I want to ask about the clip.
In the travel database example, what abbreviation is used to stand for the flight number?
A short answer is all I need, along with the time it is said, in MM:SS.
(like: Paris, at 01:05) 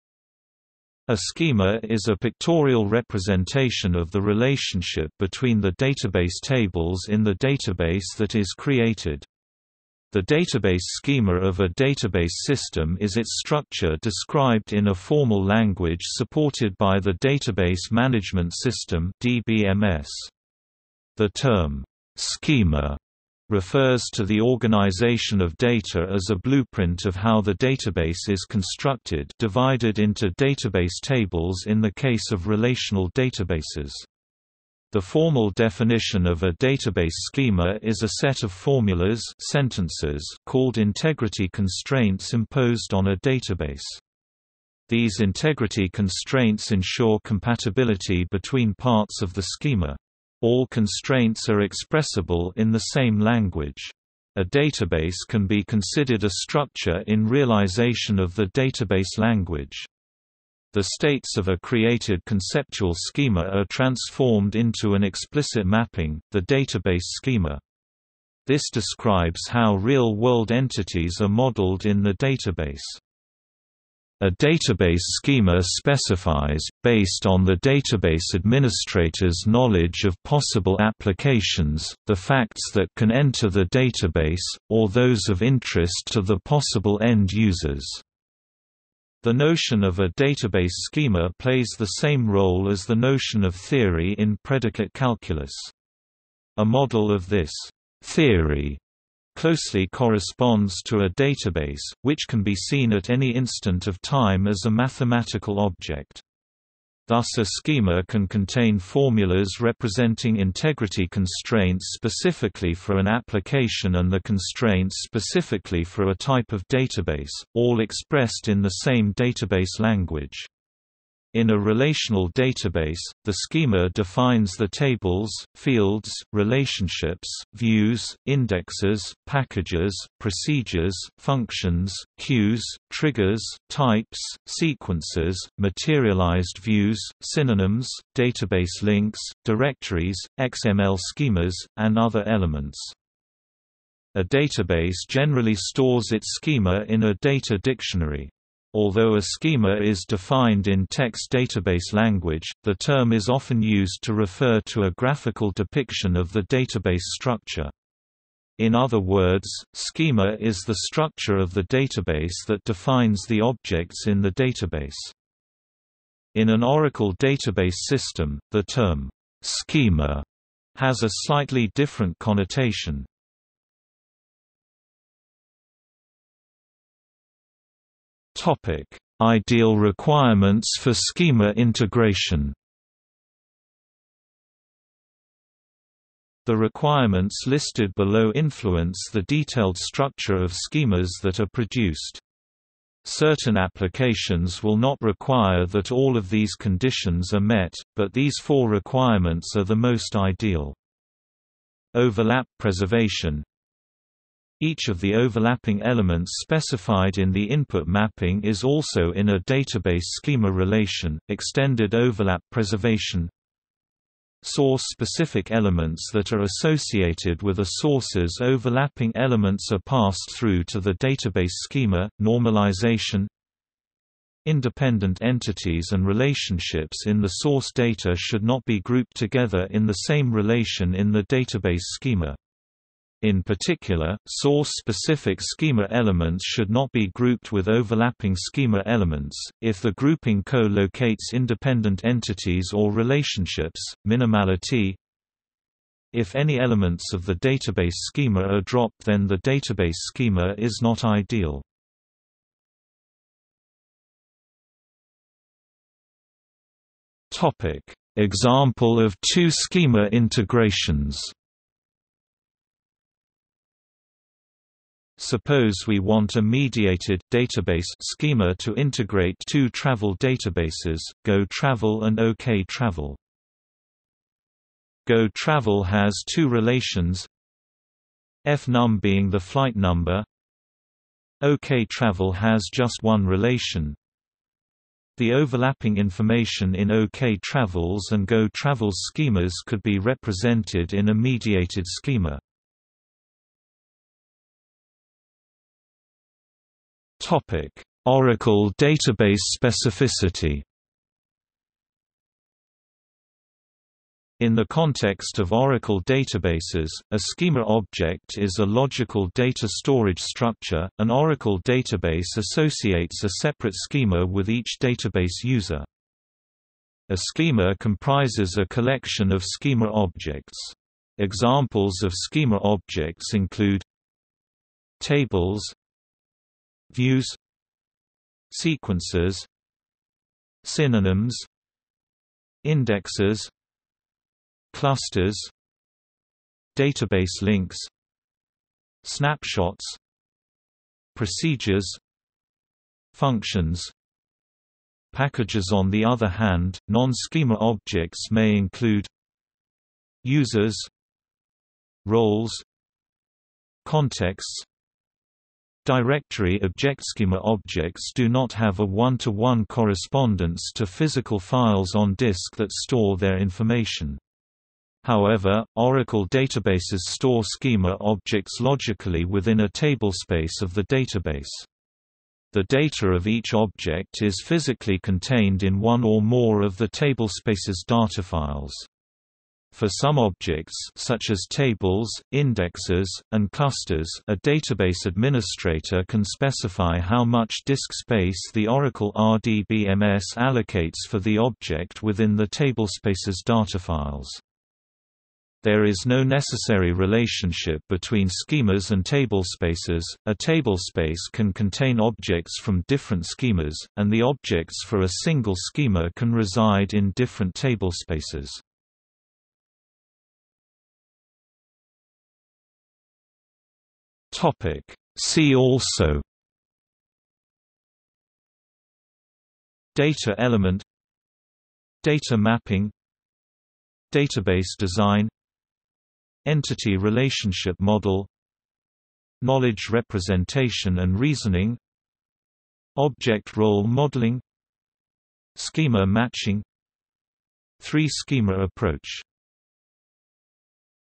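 FNUM, at 04:38.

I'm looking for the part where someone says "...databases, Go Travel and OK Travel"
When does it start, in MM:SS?
04:30.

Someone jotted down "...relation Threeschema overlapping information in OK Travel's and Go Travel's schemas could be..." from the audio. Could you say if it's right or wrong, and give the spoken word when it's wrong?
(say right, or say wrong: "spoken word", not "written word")
wrong: "The", not "Threeschema".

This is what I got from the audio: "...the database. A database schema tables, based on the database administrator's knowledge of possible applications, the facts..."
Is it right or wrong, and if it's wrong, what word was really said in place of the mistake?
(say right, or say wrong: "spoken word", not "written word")
wrong: "specifies", not "tables".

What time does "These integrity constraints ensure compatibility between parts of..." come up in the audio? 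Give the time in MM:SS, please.
00:44.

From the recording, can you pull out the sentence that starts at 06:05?
However, Oracle databases store schema objects logically within a table space of the database.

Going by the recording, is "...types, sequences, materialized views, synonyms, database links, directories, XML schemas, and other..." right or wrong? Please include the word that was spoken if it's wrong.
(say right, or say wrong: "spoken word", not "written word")
right.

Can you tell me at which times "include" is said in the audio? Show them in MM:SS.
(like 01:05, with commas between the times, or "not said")
05:23, 05:48.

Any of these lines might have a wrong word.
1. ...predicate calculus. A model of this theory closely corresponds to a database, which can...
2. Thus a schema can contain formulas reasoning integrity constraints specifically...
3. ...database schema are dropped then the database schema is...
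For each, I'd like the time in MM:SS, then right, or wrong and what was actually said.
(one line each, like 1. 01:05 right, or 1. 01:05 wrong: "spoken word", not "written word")
1. 01:34 right
2. 01:47 wrong: "representing", not "reasoning"
3. 04:07 right.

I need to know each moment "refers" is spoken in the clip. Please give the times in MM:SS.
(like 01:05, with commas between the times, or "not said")
00:23, 02:34.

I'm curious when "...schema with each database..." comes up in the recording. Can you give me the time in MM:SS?
05:13.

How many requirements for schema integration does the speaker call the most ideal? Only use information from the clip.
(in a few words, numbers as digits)
4.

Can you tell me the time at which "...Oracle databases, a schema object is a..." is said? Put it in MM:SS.
05:05.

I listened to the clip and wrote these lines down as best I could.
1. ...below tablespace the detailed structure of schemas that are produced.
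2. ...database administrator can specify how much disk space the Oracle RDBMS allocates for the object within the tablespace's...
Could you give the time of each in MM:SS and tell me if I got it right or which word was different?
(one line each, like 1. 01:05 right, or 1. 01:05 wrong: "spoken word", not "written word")
1. 03:07 wrong: "influence", not "tablespace"
2. 06:24 right.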